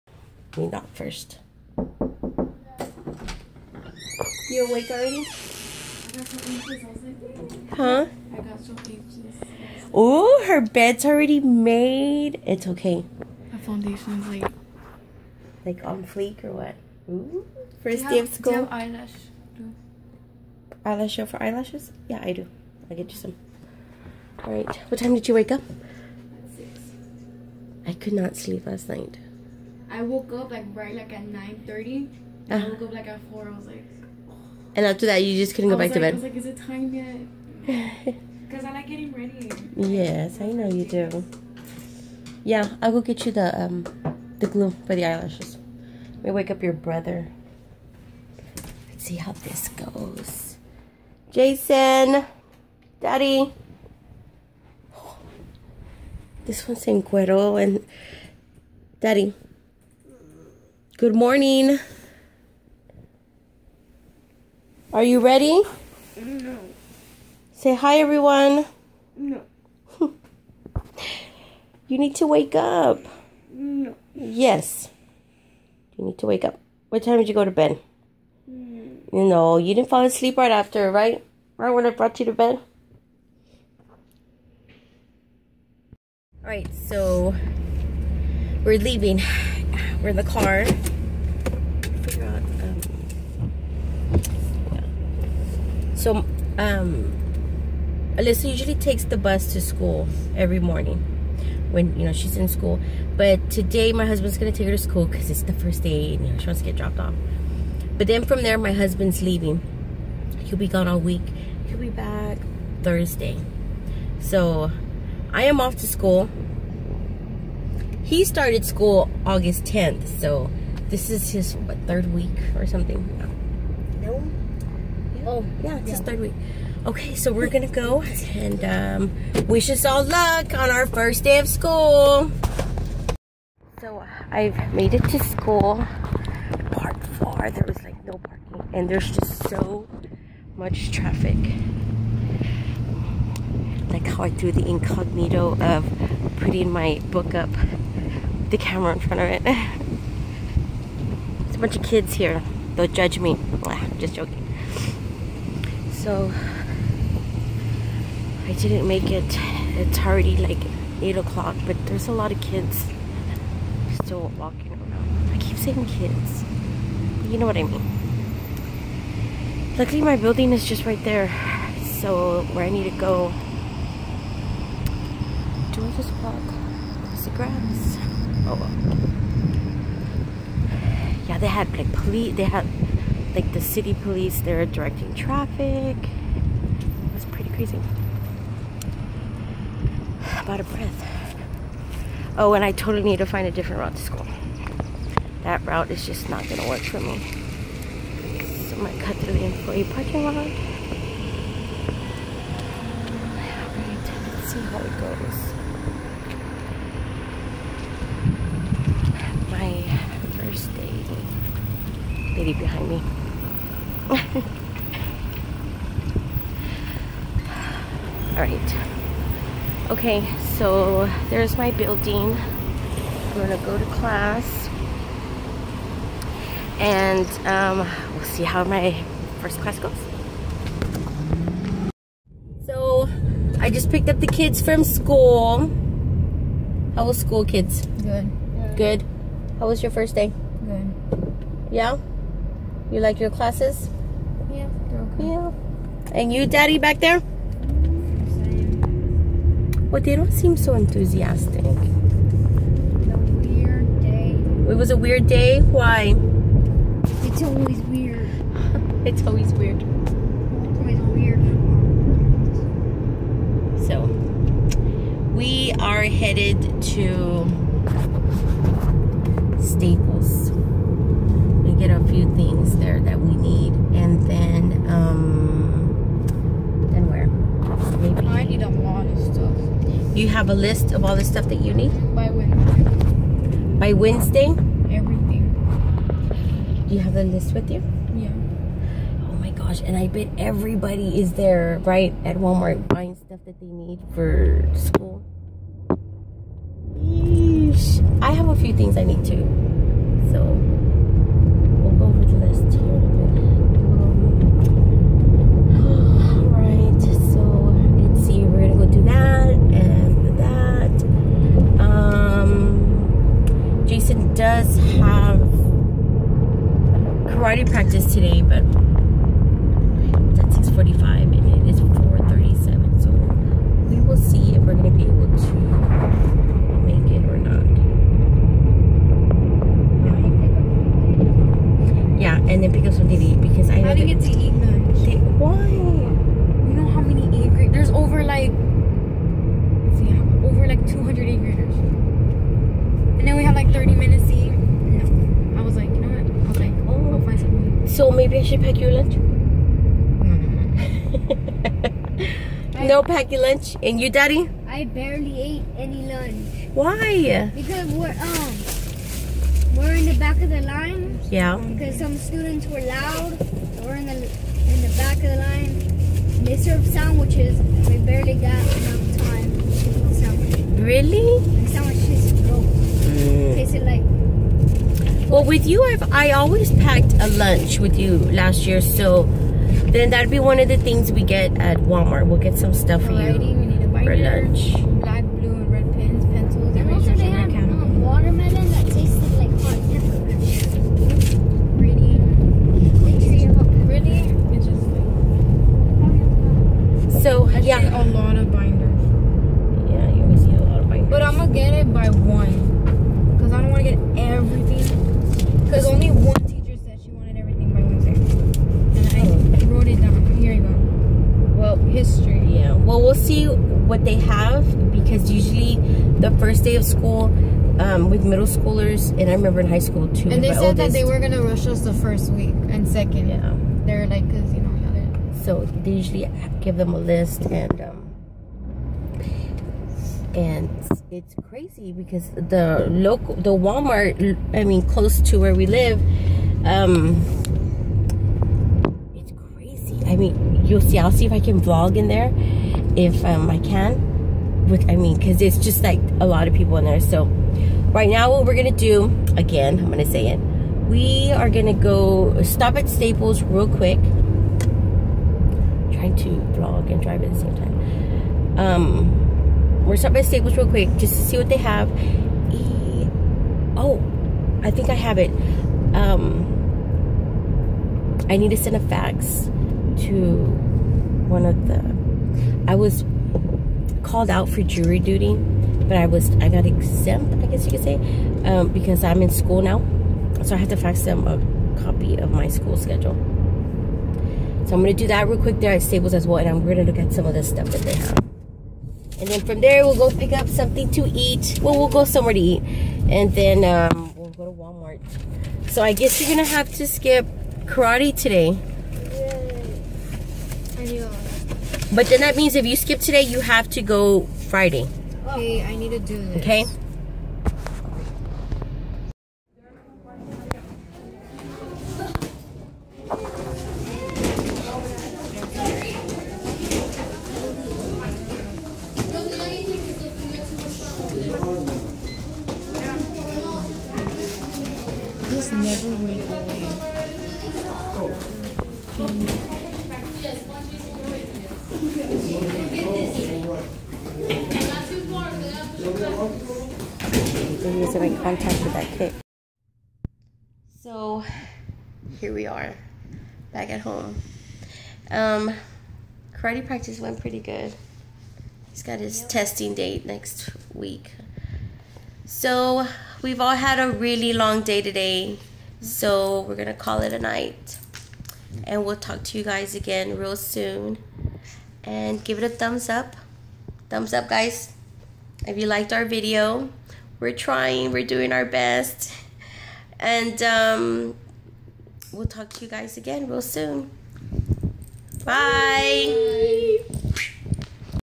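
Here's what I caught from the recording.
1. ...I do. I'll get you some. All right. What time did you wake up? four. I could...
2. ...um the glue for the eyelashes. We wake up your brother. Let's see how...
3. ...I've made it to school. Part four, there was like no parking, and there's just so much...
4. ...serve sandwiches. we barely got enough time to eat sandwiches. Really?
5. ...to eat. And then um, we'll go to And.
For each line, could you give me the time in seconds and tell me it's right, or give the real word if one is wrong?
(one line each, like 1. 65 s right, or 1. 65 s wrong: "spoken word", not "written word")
1. 22 s wrong: "six", not "four"
2. 43 s right
3. 134 s right
4. 366 s right
5. 492 s wrong: "Walmart", not "And".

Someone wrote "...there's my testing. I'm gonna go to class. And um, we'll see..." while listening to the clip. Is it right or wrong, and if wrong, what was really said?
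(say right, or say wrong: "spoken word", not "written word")
wrong: "building", not "testing".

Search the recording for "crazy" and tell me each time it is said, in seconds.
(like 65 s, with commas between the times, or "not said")
187 s, 431 s, 439 s.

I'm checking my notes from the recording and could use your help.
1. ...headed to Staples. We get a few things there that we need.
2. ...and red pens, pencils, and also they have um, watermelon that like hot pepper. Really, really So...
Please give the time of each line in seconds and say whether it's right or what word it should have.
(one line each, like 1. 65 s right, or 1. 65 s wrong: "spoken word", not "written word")
1. 266 s right
2. 385 s right.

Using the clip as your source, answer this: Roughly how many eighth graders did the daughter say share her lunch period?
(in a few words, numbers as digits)
over 200.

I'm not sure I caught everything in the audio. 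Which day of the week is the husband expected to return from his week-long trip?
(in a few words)
Thursday.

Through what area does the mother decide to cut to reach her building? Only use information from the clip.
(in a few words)
employee parking lot.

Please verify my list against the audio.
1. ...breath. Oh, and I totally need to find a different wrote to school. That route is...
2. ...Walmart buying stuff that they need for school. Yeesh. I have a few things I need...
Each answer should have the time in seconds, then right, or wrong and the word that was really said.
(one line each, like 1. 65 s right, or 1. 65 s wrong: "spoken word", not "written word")
1. 190 s wrong: "route", not "wrote"
2. 292 s right.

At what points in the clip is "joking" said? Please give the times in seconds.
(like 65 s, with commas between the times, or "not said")
154 s.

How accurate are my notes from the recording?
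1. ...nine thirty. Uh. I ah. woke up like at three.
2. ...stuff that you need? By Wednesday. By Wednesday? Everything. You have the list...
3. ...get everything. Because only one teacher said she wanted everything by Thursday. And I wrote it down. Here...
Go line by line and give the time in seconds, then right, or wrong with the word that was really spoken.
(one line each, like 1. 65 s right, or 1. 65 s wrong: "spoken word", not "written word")
1. 31 s wrong: "four", not "three"
2. 281 s right
3. 403 s wrong: "Wednesday", not "Thursday".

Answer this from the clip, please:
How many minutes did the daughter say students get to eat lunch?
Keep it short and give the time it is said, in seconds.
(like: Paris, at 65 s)
30, at 343 s.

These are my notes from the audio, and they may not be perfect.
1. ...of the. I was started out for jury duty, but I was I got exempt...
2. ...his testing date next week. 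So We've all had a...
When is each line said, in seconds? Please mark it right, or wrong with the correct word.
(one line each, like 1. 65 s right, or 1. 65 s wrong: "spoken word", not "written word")
1. 471 s wrong: "called", not "started"
2. 548 s right.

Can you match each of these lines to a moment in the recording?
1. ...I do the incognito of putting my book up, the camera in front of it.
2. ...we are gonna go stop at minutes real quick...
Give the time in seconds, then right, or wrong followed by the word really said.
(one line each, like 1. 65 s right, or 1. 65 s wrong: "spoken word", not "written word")
1. 144 s right
2. 450 s wrong: "staples", not "minutes".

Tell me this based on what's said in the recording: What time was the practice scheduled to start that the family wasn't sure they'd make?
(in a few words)
6:45.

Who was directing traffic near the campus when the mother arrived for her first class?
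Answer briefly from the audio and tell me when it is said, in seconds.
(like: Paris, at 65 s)
city police, at 183 s.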